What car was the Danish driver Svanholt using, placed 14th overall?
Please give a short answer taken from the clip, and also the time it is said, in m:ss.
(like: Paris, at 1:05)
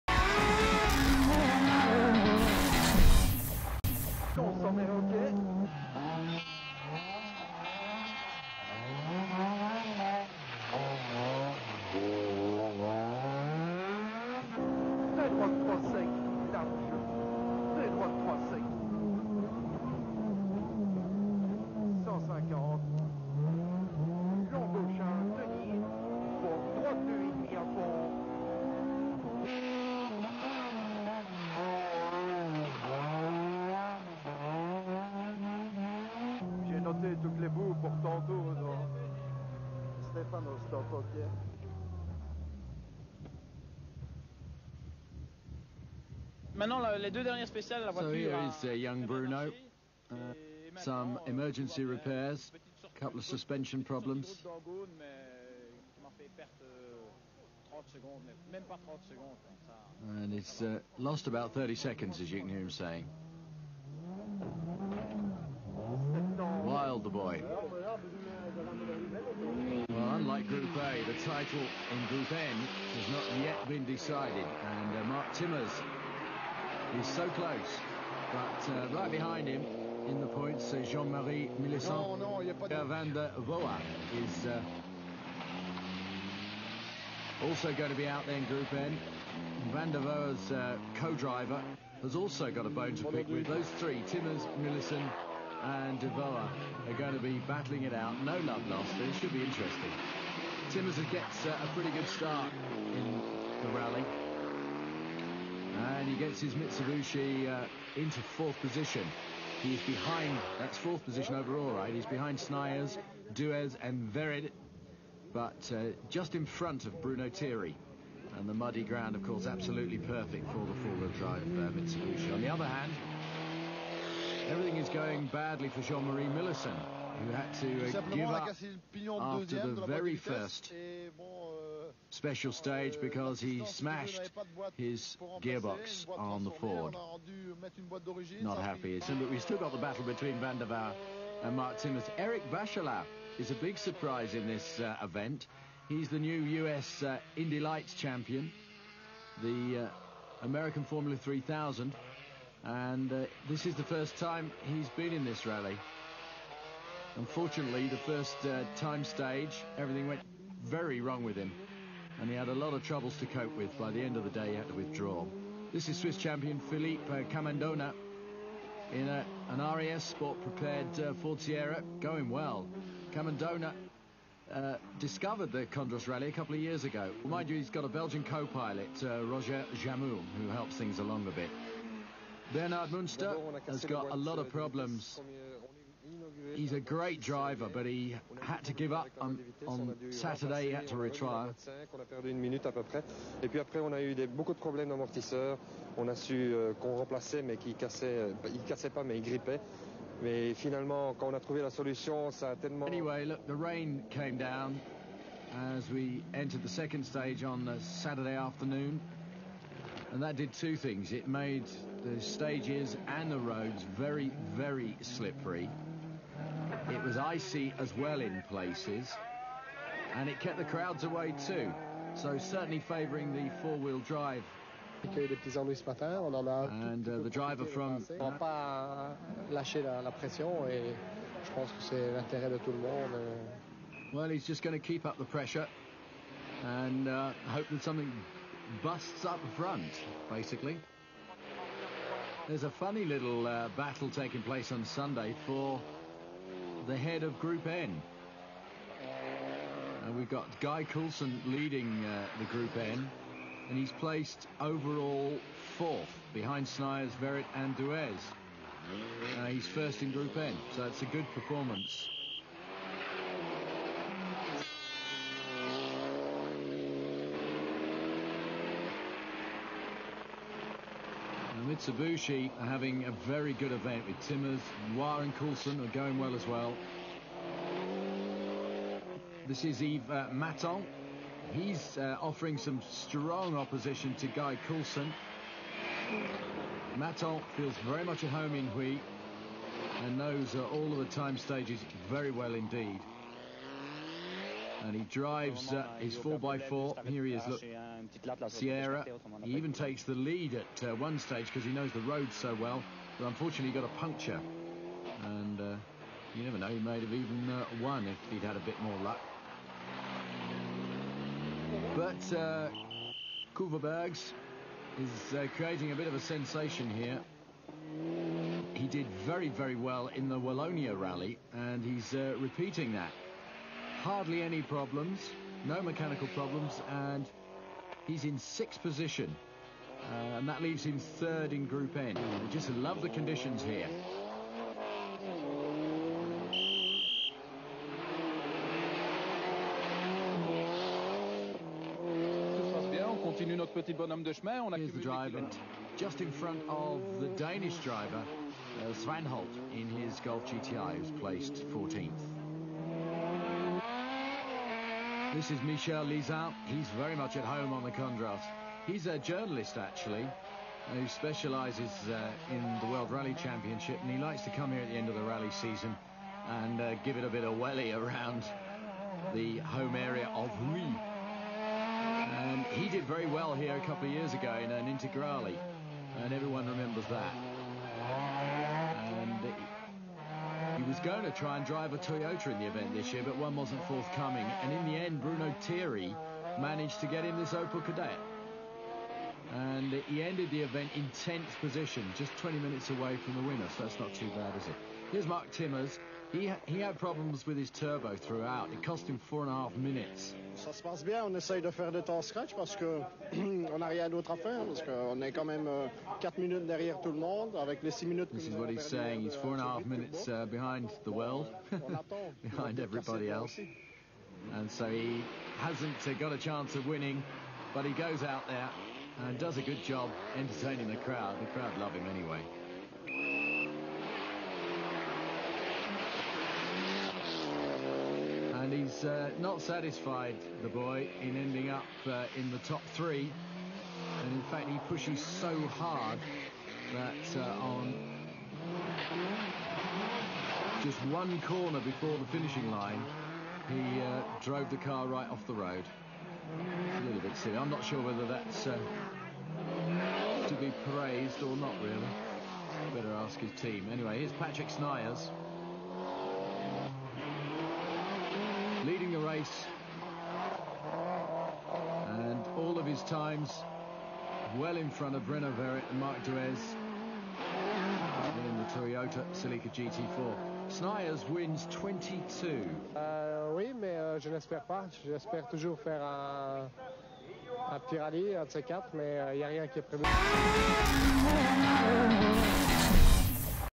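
Golf GTI, at 5:50.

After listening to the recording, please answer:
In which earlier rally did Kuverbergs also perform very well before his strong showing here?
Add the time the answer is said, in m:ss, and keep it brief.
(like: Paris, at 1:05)
Wallonia rally, at 5:20.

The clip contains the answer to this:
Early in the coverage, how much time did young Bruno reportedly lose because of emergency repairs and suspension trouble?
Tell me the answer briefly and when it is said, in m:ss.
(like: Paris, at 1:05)
30 seconds, at 1:01.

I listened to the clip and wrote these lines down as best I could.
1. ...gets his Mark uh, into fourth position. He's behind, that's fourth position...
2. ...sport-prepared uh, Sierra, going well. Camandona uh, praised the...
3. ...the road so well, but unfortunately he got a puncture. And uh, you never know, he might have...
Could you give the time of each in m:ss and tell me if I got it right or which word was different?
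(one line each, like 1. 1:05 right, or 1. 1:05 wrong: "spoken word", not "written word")
1. 1:46 wrong: "Mitsubishi", not "Mark"
2. 2:50 wrong: "discovered", not "praised"
3. 5:01 right.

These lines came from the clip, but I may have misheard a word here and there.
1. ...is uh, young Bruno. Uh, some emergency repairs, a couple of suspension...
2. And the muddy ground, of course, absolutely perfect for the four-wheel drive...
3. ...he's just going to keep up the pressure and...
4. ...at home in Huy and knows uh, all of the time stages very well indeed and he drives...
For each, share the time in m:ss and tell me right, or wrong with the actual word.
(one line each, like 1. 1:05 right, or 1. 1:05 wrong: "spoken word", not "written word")
1. 0:48 right
2. 1:58 right
3. 3:54 right
4. 4:48 right.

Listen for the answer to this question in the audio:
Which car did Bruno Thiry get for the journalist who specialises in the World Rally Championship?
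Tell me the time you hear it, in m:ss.
6:27.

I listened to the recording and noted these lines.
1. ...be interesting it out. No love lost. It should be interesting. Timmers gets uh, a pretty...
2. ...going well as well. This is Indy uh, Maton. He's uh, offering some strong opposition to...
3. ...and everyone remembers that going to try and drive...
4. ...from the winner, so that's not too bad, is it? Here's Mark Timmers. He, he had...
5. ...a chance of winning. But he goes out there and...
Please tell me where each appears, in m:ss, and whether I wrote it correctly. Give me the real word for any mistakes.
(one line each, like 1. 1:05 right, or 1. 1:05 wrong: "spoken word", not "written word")
1. 1:37 wrong: "battling", not "interesting"
2. 4:35 wrong: "Yves", not "Indy"
3. 6:16 right
4. 6:33 right
5. 6:56 right.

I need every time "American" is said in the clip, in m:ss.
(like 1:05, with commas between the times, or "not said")
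2:30.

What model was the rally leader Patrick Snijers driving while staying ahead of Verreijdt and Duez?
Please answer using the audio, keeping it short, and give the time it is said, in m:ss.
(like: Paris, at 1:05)
Toyota Celica GT4, at 7:48.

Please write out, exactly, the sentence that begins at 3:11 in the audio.
On a perdu une minute à peu près.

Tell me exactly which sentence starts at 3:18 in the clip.
Euh, il cassait pas, mais il grippait.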